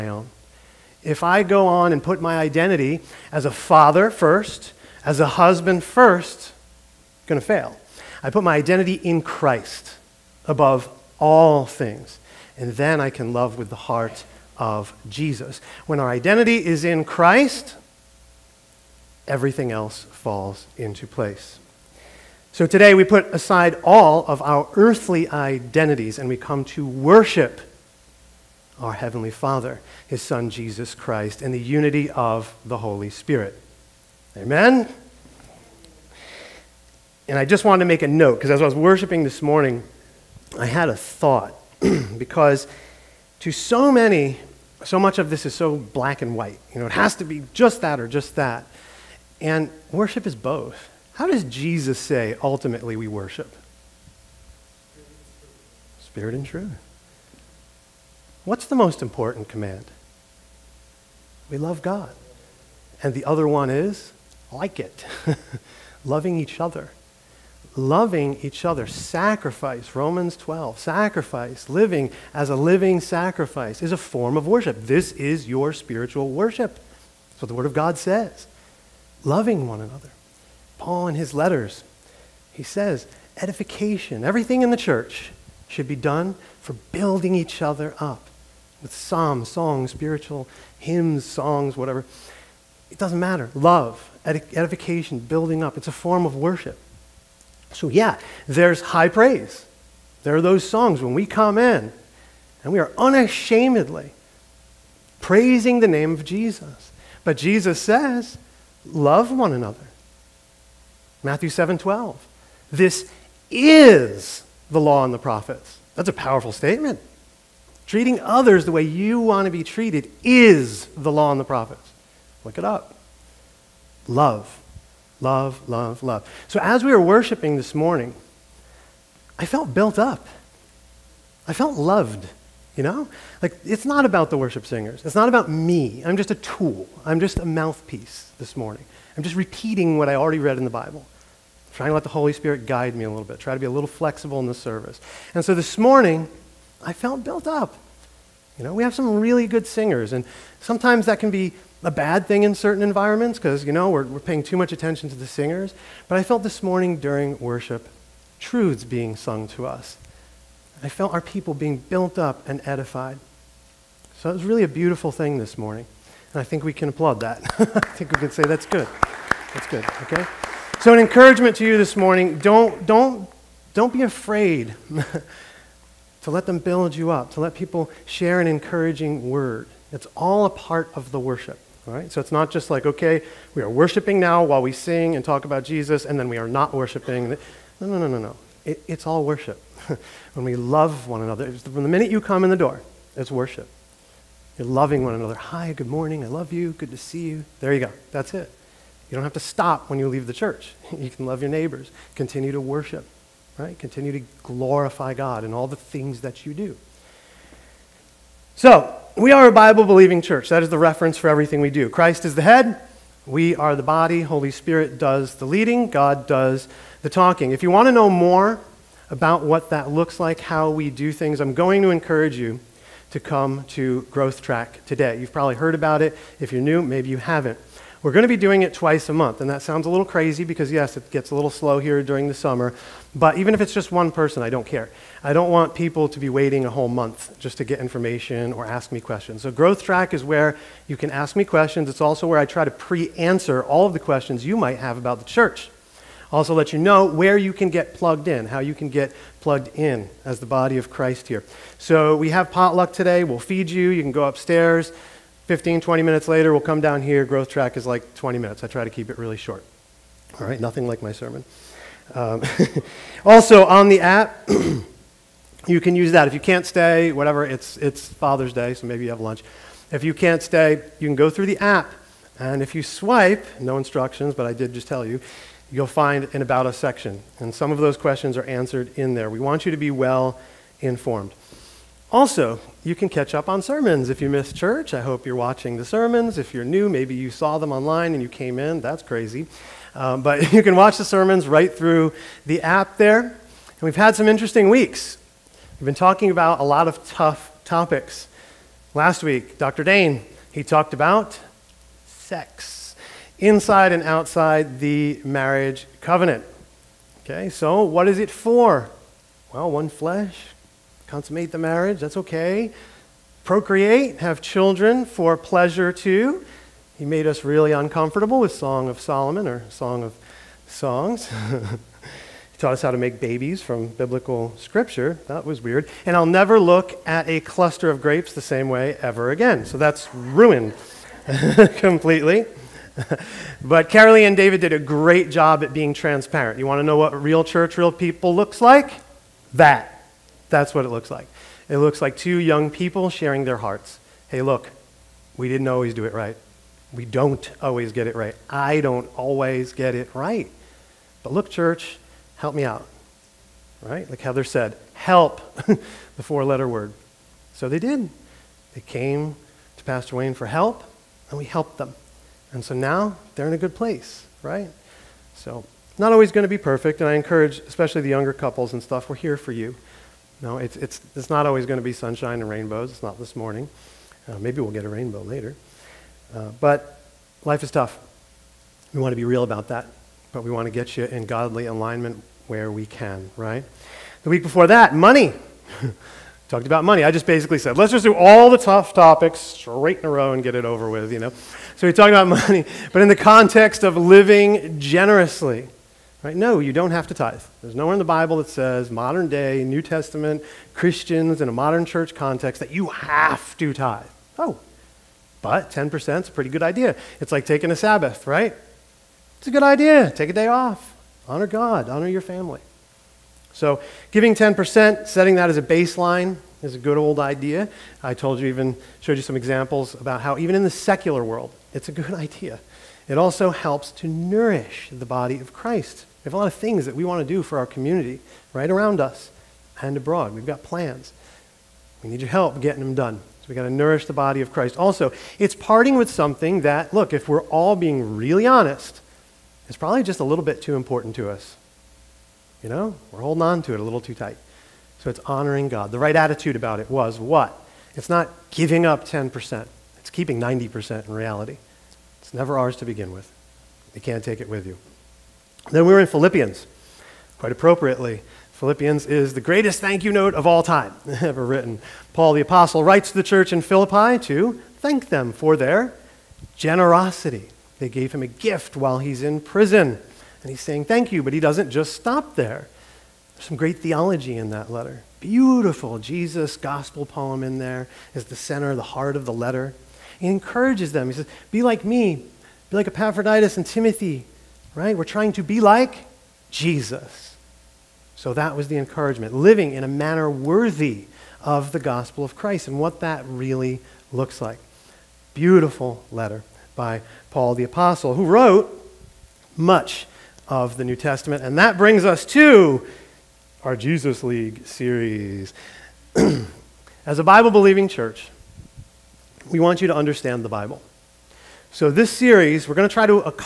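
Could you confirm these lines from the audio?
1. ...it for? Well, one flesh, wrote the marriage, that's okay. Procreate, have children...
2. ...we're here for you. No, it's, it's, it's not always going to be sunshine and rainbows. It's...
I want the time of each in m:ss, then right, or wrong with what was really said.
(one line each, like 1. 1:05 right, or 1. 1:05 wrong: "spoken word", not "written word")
1. 5:08 wrong: "consummate", not "wrote"
2. 6:09 right.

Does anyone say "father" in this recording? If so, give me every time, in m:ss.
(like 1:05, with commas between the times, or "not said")
0:03, 0:29, 4:28.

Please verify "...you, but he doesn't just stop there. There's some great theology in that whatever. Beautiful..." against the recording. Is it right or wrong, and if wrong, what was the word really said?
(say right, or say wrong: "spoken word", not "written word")
wrong: "letter", not "whatever".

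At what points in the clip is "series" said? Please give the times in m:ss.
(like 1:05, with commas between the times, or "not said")
8:24, 8:32.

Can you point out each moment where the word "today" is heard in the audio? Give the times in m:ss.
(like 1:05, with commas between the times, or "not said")
0:22, 3:44, 4:12.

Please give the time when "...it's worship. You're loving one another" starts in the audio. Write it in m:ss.
3:13.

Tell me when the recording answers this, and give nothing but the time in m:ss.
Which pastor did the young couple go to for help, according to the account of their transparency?
5:59.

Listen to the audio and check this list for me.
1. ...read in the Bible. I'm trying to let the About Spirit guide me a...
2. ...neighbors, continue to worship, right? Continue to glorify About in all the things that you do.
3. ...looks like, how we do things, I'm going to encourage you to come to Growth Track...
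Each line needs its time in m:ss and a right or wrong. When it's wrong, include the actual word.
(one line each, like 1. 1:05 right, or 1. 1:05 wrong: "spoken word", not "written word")
1. 2:20 wrong: "Holy", not "About"
2. 3:21 wrong: "God", not "About"
3. 3:39 right.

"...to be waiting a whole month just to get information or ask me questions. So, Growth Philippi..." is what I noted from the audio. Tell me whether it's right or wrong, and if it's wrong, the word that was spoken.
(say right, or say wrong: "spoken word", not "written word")
wrong: "Track", not "Philippi".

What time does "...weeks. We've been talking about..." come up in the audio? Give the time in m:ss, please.
4:54.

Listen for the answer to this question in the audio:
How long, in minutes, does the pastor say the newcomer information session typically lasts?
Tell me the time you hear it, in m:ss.
4:17.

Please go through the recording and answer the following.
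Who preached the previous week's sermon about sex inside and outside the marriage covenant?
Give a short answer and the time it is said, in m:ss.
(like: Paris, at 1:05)
Dr. Dane, at 4:59.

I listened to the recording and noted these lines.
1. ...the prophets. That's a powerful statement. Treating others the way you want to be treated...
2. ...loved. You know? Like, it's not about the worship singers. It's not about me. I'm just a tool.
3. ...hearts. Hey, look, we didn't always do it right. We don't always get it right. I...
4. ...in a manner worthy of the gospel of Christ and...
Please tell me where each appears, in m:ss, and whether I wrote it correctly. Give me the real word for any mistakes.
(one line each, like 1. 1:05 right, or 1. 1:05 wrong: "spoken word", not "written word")
1. 1:55 right
2. 2:11 right
3. 5:43 right
4. 8:09 right.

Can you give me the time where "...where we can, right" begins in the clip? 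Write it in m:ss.
6:22.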